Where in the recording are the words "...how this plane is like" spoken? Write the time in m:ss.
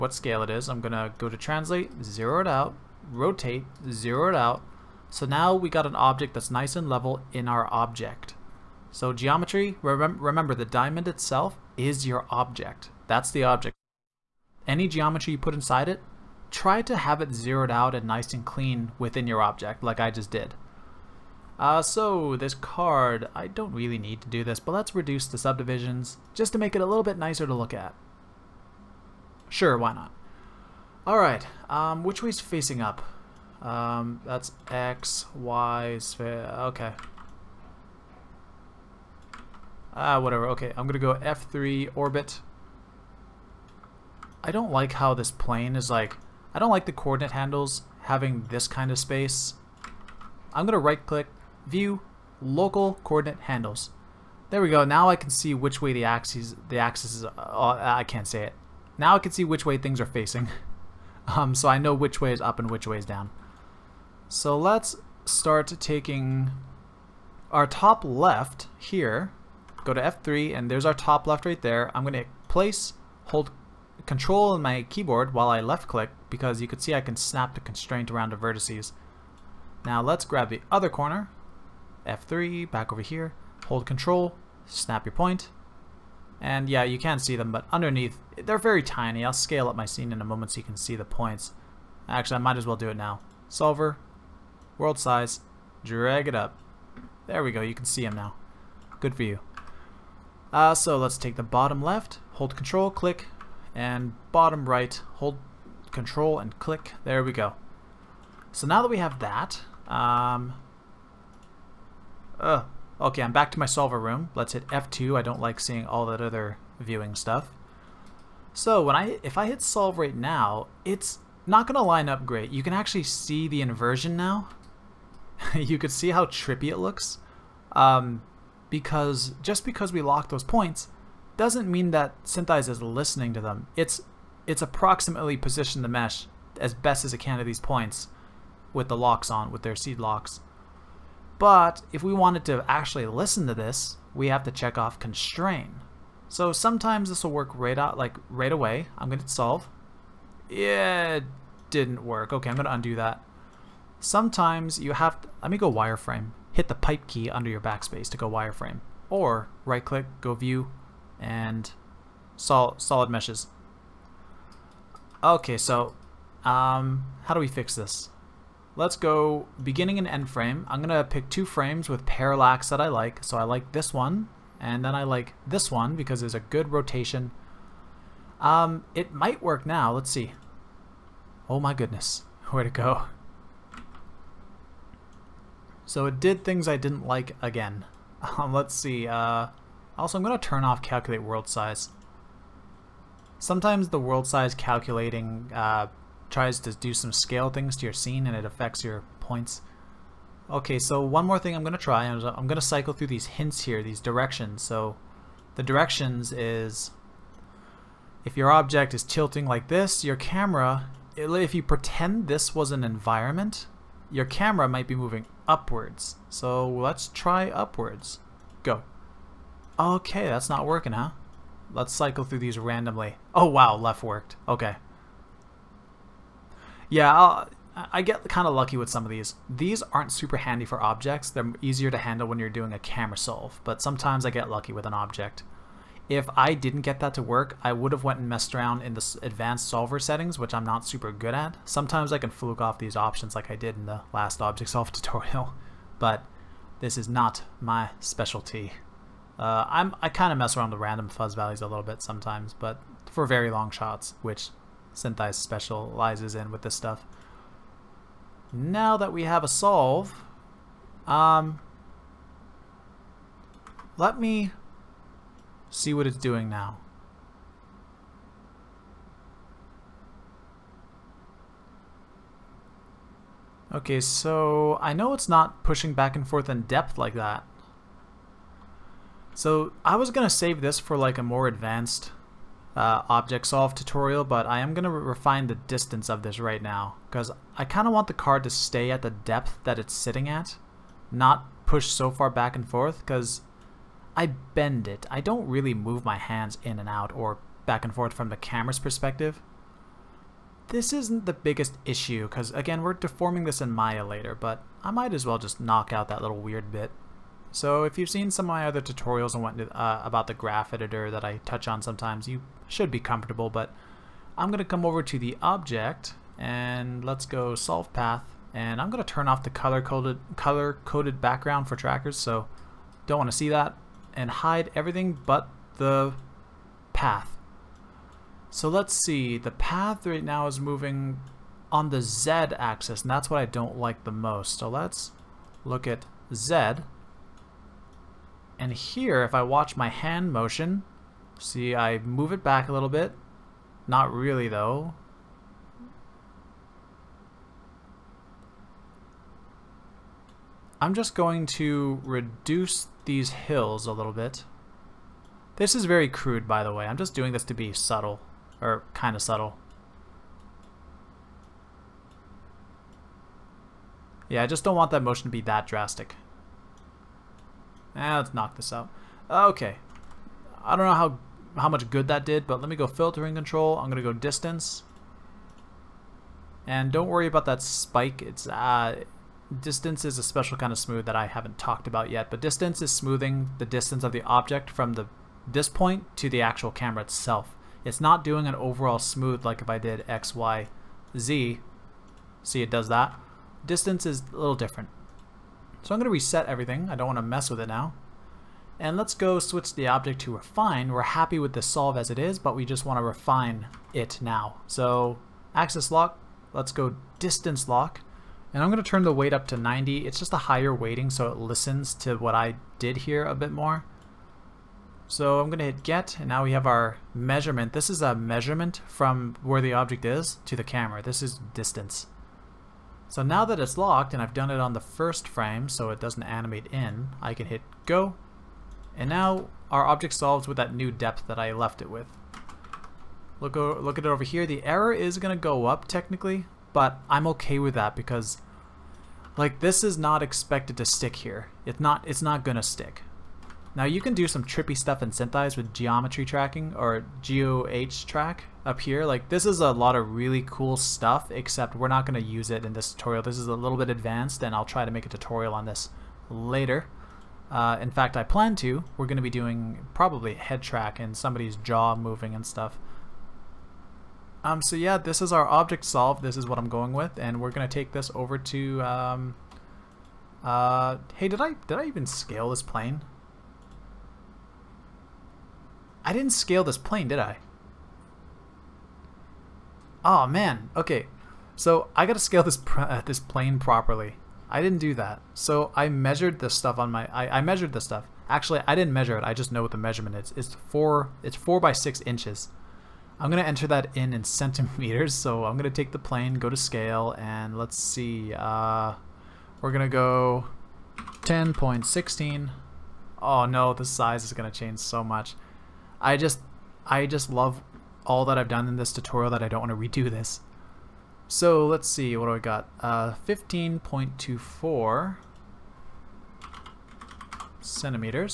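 0:44.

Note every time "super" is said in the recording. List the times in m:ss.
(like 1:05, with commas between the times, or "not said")
3:50, 4:00.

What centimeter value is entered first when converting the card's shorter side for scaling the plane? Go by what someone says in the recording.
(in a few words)
10.16.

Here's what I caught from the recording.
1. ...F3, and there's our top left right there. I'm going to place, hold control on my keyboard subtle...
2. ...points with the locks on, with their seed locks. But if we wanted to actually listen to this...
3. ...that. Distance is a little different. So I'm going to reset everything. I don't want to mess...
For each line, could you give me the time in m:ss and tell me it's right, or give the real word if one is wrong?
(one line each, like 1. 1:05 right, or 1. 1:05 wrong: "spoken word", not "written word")
1. 1:10 wrong: "while", not "subtle"
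2. 2:17 right
3. 6:32 right.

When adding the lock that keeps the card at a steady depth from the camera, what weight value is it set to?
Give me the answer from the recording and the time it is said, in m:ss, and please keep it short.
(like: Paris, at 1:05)
90, at 6:49.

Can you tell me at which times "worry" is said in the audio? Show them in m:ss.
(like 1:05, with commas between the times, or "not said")
6:17.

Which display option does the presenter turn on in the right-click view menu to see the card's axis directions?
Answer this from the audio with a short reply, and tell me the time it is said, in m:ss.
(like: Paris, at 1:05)
Local coordinate handles, at 0:52.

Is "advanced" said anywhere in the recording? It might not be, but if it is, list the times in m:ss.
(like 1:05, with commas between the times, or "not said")
3:59, 4:41, 7:33.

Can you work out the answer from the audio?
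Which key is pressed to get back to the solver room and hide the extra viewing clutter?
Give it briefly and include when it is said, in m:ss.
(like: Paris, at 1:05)
F2, at 1:54.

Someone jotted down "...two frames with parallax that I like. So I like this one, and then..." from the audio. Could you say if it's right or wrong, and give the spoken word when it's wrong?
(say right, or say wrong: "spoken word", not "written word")
right.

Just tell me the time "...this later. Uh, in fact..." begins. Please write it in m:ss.
7:35.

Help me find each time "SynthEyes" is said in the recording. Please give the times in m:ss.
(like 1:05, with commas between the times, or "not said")
2:12, 4:14, 7:25.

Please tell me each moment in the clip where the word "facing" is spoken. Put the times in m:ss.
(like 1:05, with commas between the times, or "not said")
0:32, 1:00.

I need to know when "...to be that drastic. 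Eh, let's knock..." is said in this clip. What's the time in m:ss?
6:05.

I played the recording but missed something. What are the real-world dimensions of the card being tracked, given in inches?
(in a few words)
4 by 6 inches.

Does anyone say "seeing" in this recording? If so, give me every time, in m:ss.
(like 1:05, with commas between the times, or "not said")
1:55.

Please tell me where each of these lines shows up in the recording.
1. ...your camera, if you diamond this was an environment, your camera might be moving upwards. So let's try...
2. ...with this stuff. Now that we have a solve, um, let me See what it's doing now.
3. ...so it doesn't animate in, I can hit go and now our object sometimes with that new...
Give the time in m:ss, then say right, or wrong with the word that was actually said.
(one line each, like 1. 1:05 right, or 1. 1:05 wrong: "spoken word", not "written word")
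1. 3:30 wrong: "pretend", not "diamond"
2. 4:16 right
3. 7:05 wrong: "solves", not "sometimes".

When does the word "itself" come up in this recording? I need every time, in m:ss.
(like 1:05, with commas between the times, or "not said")
0:11, 6:27.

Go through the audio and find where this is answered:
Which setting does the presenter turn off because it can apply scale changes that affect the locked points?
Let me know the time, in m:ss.
3:10.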